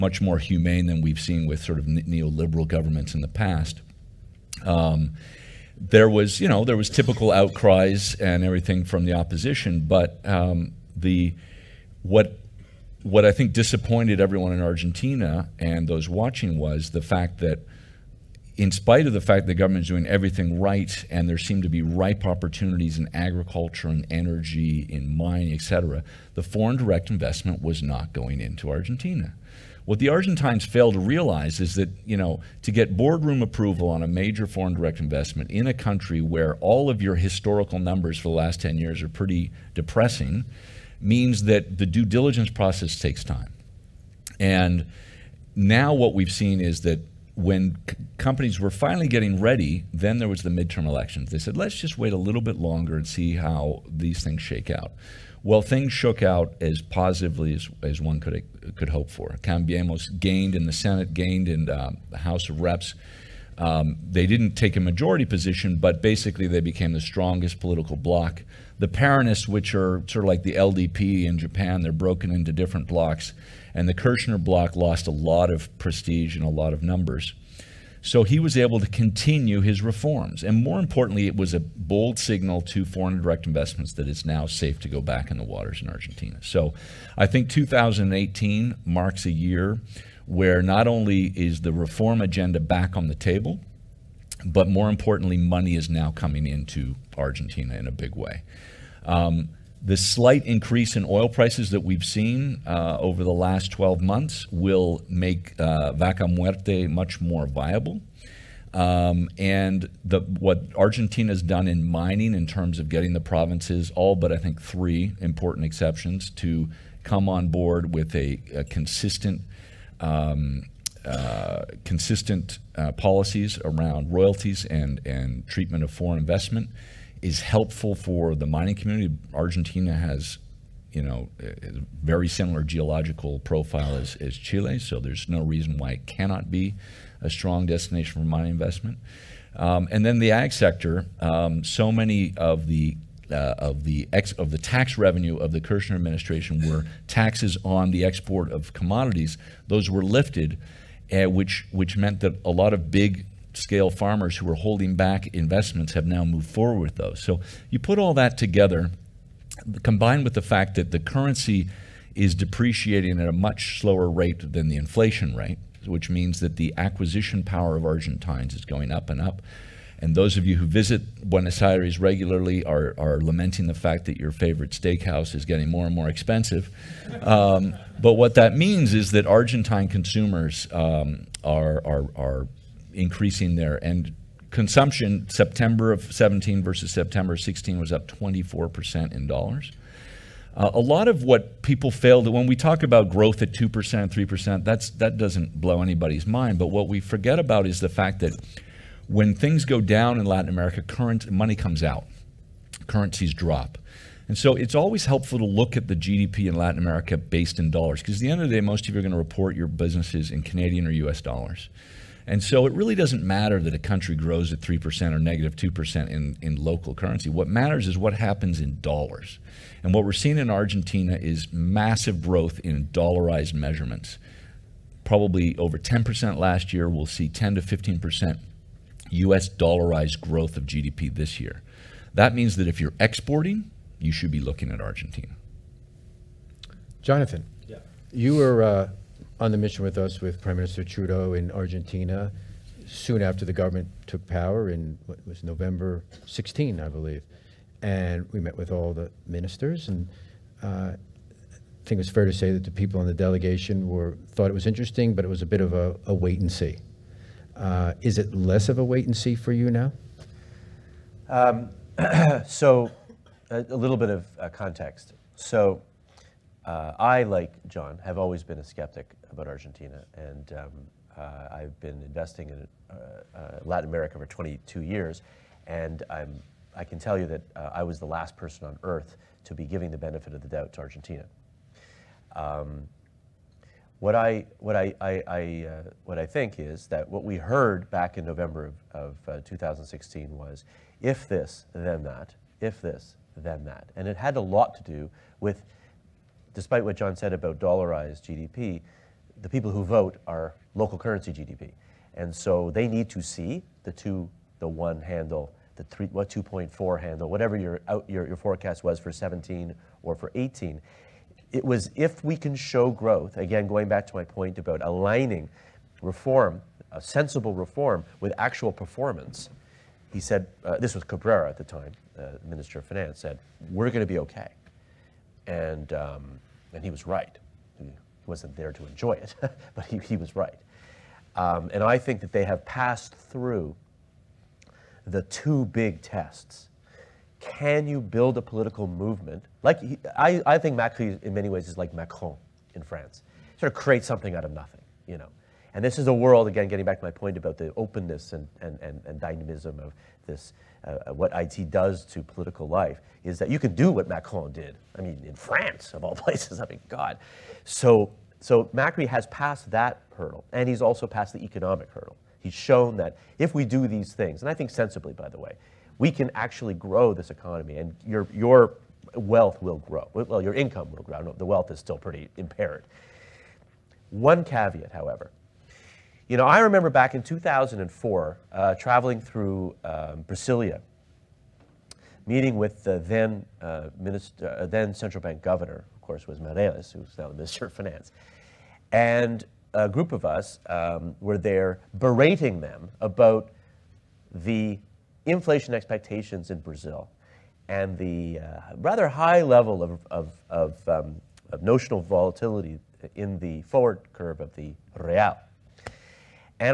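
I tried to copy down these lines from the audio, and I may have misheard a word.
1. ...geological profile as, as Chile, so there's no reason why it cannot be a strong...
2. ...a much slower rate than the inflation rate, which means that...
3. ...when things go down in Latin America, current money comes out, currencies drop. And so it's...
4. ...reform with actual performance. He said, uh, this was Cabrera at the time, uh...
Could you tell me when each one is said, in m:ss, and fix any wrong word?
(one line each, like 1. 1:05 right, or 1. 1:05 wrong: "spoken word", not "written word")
1. 2:12 right
2. 2:43 right
3. 3:19 right
4. 5:17 right.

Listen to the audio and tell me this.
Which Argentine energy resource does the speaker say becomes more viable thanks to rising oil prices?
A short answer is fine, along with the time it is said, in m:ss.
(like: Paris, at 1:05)
Vaca Muerte, at 1:45.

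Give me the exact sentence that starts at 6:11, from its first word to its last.
the wealth is still pretty impaired.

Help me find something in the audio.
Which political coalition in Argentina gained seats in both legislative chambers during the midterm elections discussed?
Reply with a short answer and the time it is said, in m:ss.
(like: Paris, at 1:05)
Cambiemos, at 0:59.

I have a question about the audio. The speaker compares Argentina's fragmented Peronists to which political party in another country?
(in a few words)
LDP.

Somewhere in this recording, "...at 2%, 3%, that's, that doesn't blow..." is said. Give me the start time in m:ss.
3:13.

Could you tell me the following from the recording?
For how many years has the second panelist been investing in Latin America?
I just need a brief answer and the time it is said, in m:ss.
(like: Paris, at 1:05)
22, at 4:34.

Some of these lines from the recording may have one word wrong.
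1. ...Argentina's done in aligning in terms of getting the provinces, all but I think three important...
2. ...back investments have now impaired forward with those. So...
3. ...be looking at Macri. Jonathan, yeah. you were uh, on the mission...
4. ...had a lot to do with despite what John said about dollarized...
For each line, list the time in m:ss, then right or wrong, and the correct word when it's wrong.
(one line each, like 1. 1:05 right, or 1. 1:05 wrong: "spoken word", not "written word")
1. 1:50 wrong: "mining", not "aligning"
2. 2:34 wrong: "moved", not "impaired"
3. 3:54 wrong: "Argentina", not "Macri"
4. 4:54 right.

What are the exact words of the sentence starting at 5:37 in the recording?
Can you build a political movement?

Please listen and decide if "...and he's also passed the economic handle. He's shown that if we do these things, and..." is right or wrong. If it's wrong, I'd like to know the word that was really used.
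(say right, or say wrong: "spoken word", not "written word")
wrong: "hurdle", not "handle".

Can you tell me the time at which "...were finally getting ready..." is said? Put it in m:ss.
0:48.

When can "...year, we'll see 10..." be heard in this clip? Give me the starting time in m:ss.
3:46.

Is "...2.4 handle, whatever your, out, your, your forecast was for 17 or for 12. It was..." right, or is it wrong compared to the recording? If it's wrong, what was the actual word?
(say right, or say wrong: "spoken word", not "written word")
wrong: "18", not "12".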